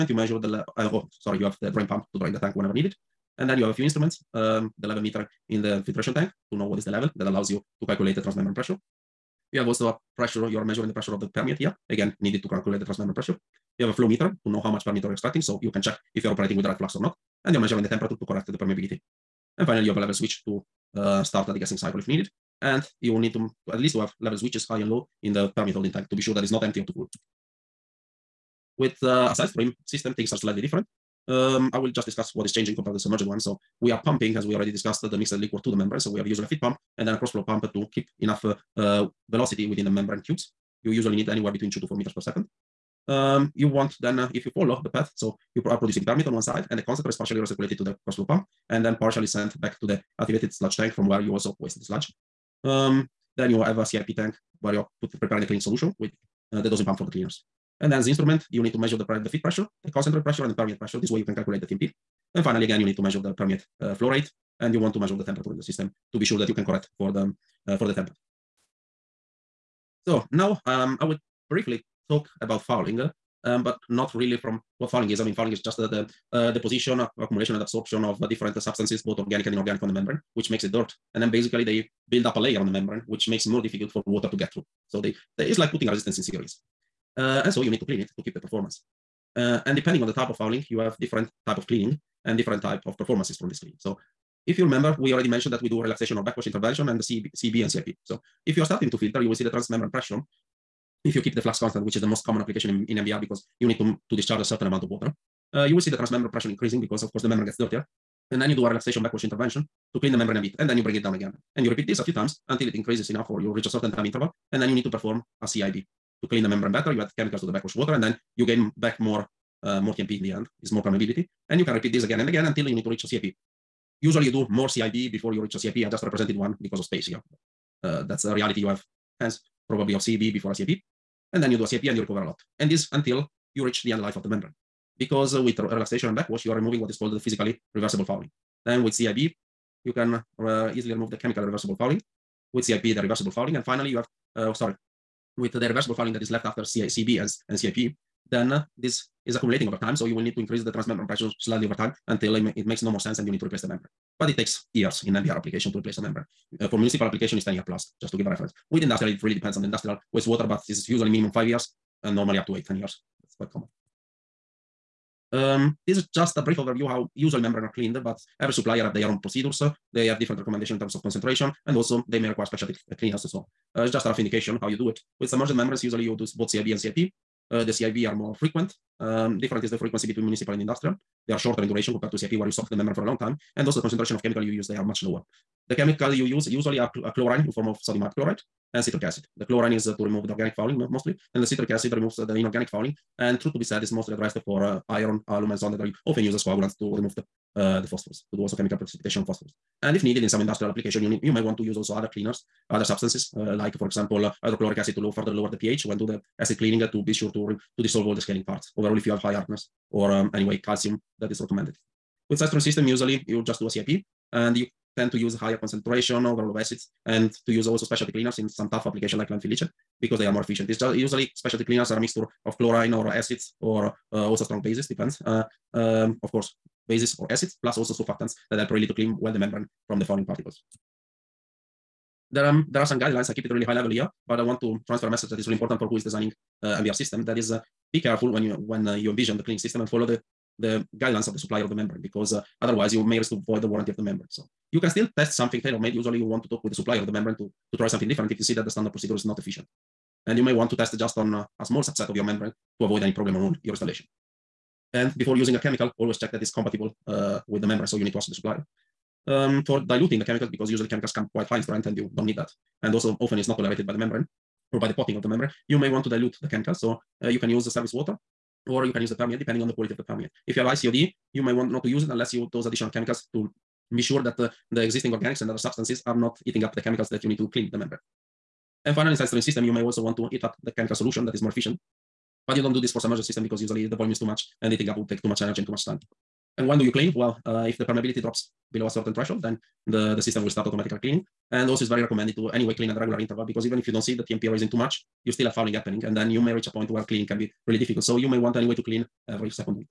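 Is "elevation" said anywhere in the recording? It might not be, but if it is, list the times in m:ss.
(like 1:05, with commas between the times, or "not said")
not said.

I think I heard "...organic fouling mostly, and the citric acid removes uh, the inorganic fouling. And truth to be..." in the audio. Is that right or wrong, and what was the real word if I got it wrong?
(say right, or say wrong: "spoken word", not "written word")
right.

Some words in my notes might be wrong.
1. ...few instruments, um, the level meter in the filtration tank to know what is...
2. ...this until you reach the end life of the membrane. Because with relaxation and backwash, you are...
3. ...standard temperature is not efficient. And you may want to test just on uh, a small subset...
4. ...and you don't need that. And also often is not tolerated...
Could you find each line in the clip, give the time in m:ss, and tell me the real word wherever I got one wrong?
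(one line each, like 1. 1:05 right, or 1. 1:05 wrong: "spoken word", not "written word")
1. 0:03 right
2. 2:12 right
3. 4:08 wrong: "procedure", not "temperature"
4. 4:21 right.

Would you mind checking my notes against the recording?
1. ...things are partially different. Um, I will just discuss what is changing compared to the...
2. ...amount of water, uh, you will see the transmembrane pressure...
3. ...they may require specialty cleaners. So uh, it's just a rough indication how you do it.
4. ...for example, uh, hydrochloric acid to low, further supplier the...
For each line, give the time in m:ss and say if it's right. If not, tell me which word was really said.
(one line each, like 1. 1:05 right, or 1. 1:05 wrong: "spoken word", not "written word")
1. 0:30 wrong: "slightly", not "partially"
2. 1:44 right
3. 2:52 right
4. 3:23 wrong: "lower", not "supplier".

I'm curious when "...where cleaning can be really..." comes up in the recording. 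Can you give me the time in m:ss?
4:56.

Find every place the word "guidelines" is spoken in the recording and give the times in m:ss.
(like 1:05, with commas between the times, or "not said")
3:52, 4:00.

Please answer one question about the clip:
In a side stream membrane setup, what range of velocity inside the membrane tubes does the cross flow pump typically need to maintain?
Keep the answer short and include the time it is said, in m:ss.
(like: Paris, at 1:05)
2 to 4 meters per second, at 0:41.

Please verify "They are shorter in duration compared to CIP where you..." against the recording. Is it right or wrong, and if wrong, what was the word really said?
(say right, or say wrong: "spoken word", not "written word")
right.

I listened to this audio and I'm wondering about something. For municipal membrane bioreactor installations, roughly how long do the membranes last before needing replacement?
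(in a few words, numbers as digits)
10 years plus.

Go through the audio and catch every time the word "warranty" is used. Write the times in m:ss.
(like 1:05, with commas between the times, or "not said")
4:03.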